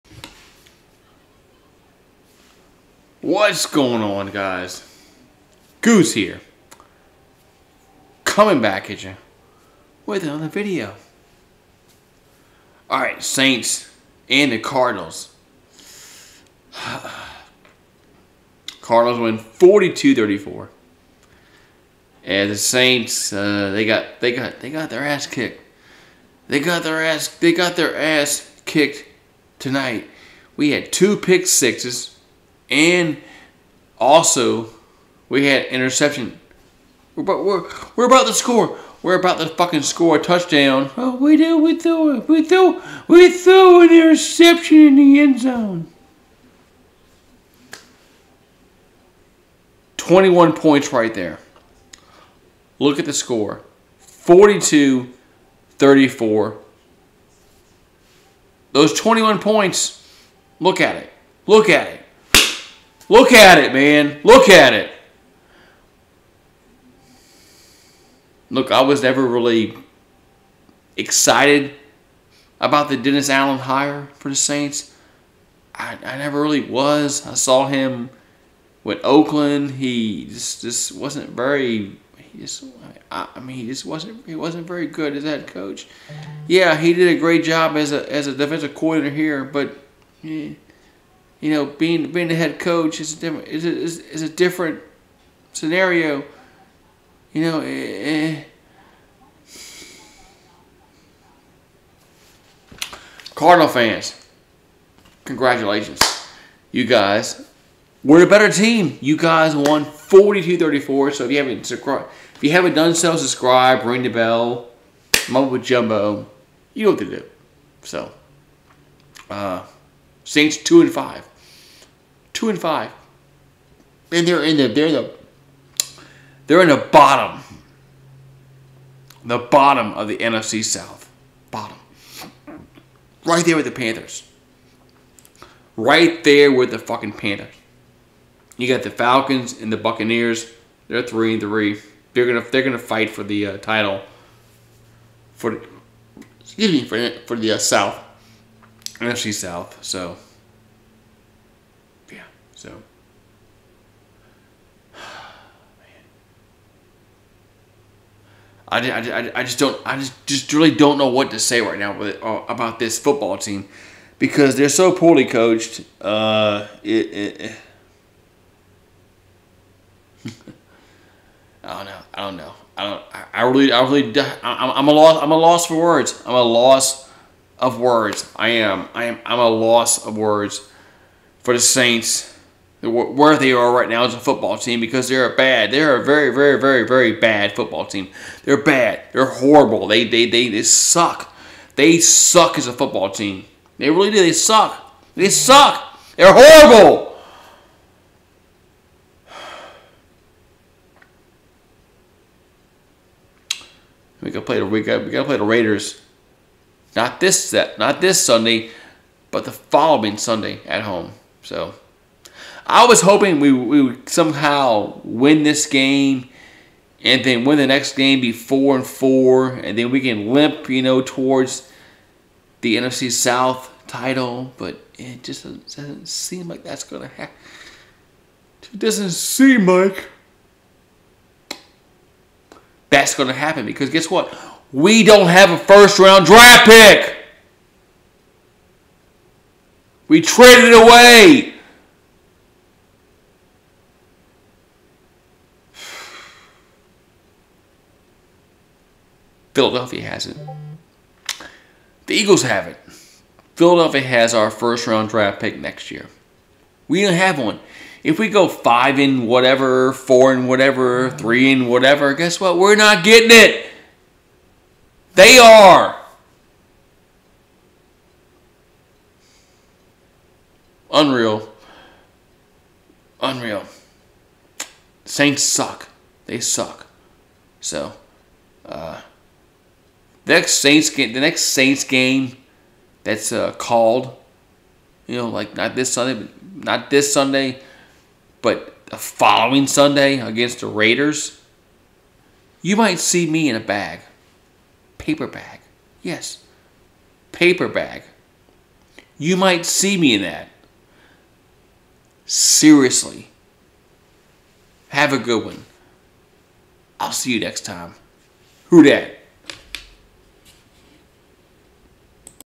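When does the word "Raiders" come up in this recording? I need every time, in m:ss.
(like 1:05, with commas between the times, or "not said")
3:25, 4:50.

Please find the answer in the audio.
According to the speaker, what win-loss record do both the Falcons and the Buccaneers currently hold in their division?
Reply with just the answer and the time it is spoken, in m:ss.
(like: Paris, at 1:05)
3 and 3, at 2:21.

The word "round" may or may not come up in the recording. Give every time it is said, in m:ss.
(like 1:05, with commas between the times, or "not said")
3:55, 4:14.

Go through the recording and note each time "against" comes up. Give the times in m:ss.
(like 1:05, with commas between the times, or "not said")
4:50.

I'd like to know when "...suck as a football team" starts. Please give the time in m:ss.
3:11.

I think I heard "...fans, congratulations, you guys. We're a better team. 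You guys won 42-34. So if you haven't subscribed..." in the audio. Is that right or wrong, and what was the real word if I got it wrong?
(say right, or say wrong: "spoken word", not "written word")
right.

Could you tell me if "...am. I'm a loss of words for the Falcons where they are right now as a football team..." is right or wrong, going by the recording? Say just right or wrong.
wrong.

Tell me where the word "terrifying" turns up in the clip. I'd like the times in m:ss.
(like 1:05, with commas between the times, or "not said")
not said.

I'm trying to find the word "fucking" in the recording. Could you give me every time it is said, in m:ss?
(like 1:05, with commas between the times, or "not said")
0:39, 2:16.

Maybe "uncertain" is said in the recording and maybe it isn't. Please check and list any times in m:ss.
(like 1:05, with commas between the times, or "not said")
not said.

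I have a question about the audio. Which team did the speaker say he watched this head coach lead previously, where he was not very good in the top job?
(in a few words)
Oakland.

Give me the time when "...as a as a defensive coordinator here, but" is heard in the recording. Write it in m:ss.
1:27.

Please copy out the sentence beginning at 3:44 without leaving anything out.
But it just doesn't, doesn't seem like that's gonna happen.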